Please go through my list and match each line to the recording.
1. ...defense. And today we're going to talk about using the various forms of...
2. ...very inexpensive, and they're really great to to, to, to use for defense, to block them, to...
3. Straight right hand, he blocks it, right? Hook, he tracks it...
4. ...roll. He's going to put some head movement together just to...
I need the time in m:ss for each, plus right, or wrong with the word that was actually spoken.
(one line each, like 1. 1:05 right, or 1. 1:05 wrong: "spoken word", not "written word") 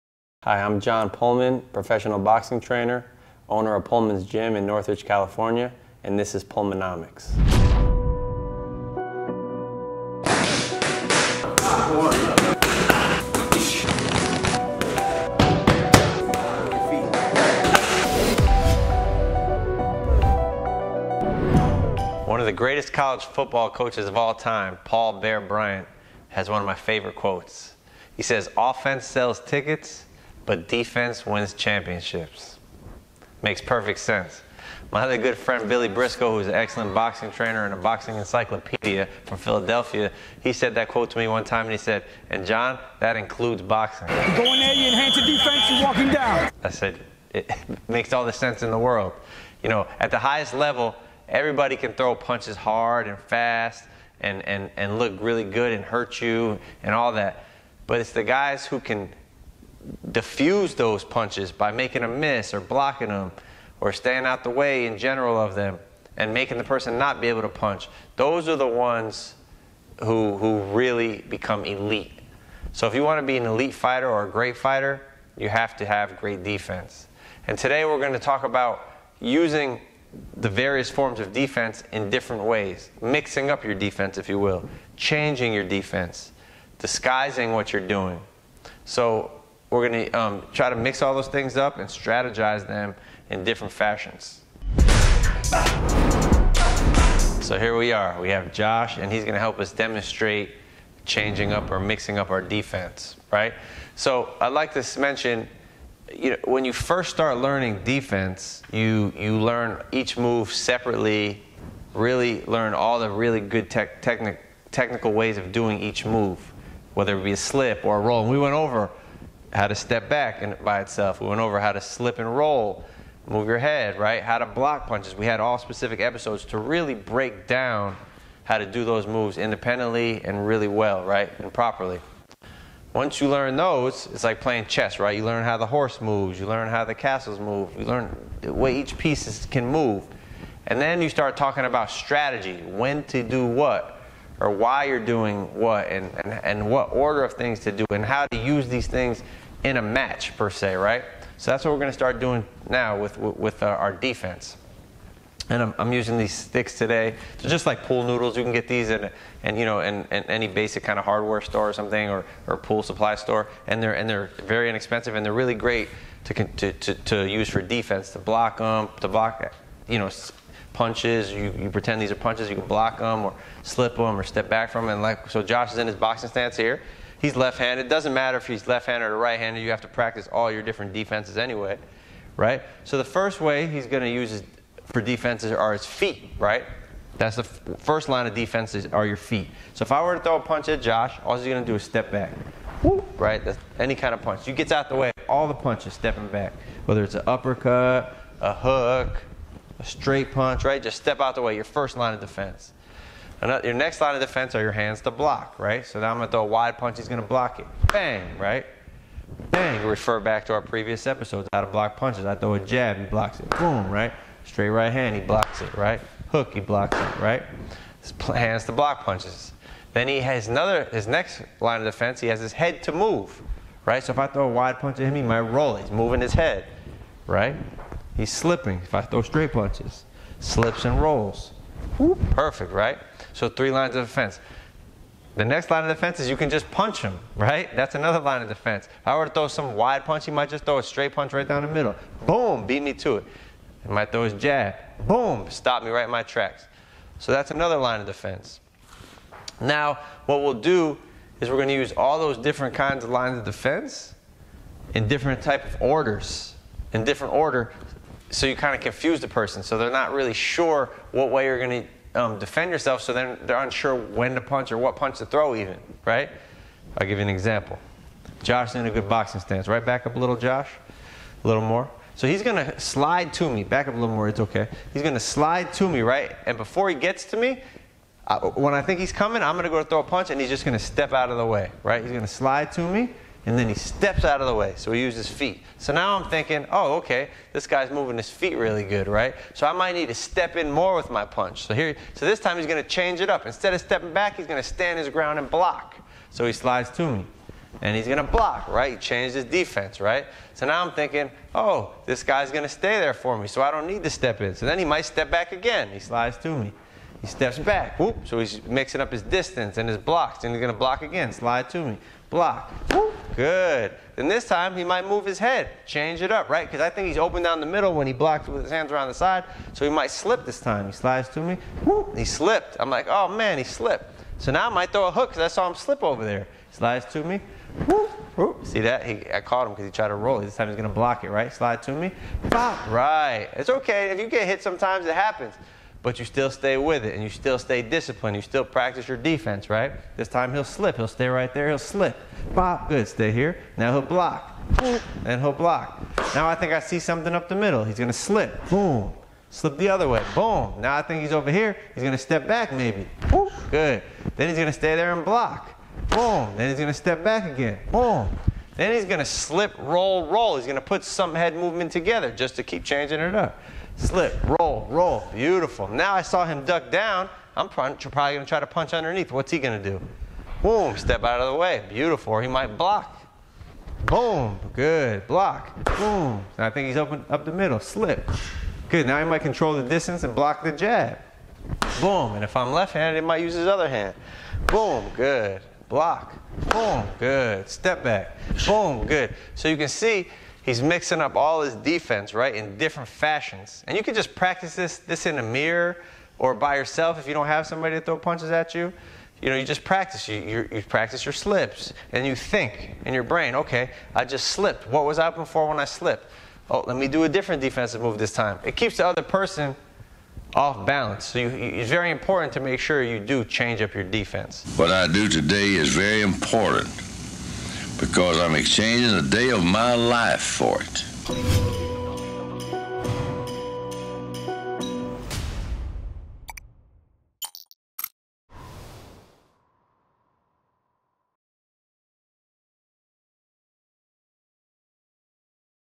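1. 1:16 right
2. 2:44 right
3. 3:34 wrong: "blocks", not "tracks"
4. 6:00 right.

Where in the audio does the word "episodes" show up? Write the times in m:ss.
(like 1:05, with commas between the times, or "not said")
2:05, 3:31.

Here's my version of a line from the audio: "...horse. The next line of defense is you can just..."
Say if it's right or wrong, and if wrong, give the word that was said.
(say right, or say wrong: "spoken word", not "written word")
wrong: "defense", not "horse".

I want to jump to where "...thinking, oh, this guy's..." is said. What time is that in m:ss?
5:00.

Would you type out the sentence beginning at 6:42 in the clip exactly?
And you think in your brain, okay, I just slipped.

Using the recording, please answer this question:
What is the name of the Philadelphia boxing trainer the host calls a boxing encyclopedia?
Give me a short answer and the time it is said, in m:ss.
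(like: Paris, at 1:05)
Billy Briscoe, at 0:35.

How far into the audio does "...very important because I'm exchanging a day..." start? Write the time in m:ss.
6:55.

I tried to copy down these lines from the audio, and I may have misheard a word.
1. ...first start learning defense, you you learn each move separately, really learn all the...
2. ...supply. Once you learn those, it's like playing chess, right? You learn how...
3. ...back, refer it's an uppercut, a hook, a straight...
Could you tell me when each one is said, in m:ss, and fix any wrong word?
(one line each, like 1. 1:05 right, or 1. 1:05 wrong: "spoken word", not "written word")
1. 1:46 right
2. 2:11 wrong: "properly", not "supply"
3. 3:16 wrong: "whether", not "refer".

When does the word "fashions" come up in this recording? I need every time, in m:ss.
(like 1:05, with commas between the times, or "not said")
1:33, 6:33.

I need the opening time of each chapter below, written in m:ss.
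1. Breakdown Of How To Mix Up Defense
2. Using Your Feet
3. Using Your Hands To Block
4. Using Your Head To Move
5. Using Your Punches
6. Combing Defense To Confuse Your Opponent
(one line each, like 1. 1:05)
1. 1:37
2. 3:02
3. 3:23
4. 3:40
5. 3:54
6. 4:10.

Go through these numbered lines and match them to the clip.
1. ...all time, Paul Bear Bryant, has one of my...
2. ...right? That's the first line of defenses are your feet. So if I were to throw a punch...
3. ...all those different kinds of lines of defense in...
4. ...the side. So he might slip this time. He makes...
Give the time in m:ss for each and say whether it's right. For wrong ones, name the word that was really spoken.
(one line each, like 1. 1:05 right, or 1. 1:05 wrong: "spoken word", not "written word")
1. 0:24 right
2. 3:06 right
3. 4:11 right
4. 5:19 wrong: "slides", not "makes".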